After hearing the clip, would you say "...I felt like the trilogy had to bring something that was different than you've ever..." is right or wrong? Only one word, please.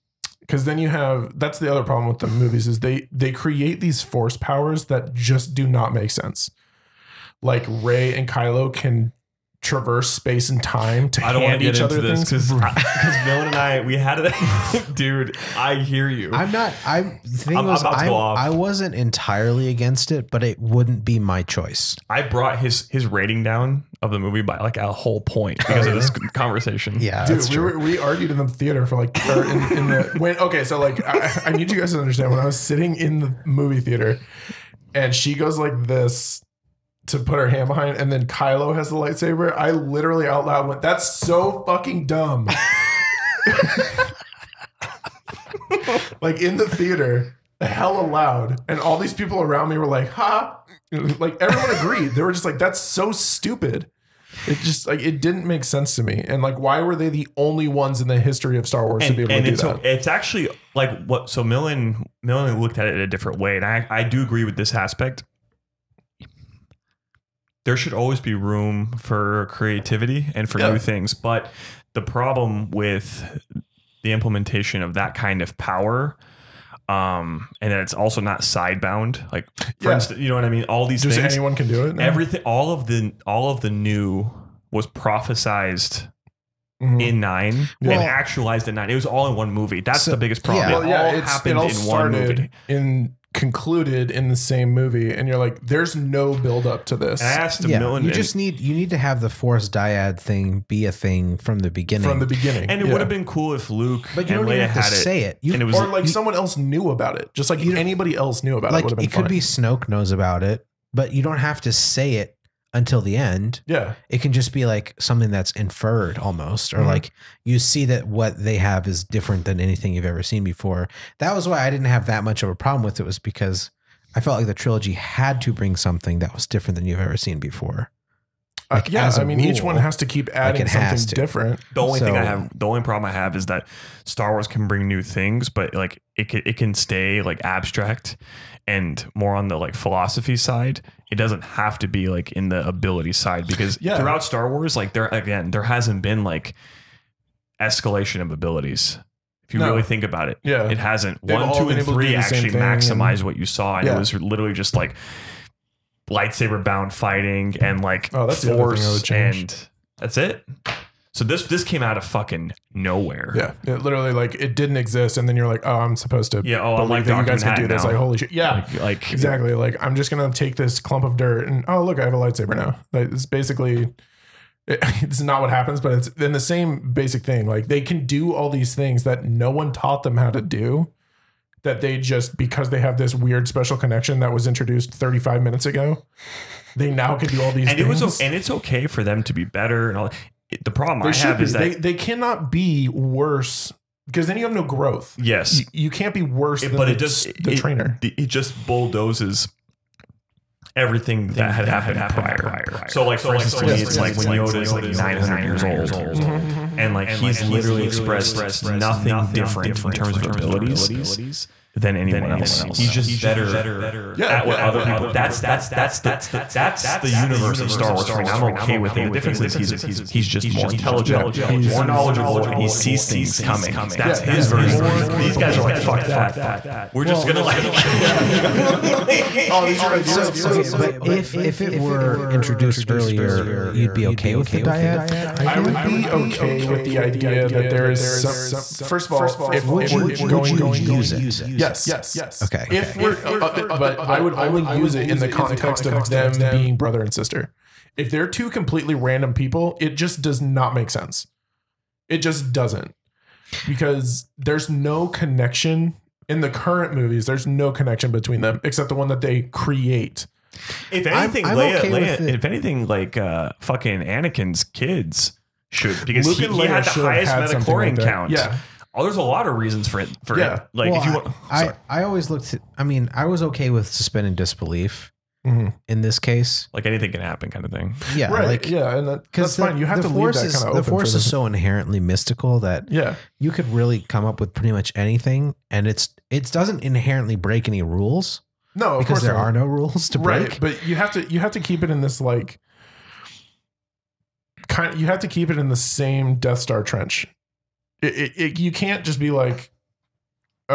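right.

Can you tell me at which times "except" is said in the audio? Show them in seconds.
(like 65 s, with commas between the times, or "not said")
258 s.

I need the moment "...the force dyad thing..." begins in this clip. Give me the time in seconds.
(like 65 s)
99 s.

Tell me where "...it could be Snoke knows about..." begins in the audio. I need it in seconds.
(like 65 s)
109 s.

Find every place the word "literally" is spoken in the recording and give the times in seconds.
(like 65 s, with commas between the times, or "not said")
39 s, 154 s, 163 s, 207 s.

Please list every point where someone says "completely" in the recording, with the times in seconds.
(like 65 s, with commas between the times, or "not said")
248 s.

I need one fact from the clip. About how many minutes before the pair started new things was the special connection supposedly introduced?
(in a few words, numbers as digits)
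35.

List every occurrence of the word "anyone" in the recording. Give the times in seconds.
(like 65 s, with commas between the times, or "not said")
81 s, 211 s.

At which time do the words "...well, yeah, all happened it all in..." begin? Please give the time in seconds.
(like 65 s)
90 s.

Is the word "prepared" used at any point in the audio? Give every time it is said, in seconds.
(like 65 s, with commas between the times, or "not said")
not said.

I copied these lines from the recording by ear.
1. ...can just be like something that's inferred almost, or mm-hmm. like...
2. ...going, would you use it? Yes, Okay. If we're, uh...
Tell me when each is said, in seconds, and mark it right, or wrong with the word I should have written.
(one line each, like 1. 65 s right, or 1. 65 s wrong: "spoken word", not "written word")
1. 114 s right
2. 240 s right.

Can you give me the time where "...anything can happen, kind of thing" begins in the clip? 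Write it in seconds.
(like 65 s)
276 s.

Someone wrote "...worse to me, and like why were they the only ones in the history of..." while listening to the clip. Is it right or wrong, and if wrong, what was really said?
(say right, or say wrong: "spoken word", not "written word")
wrong: "sense", not "worse".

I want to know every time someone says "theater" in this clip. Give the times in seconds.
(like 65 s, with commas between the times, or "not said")
28 s, 33 s, 46 s.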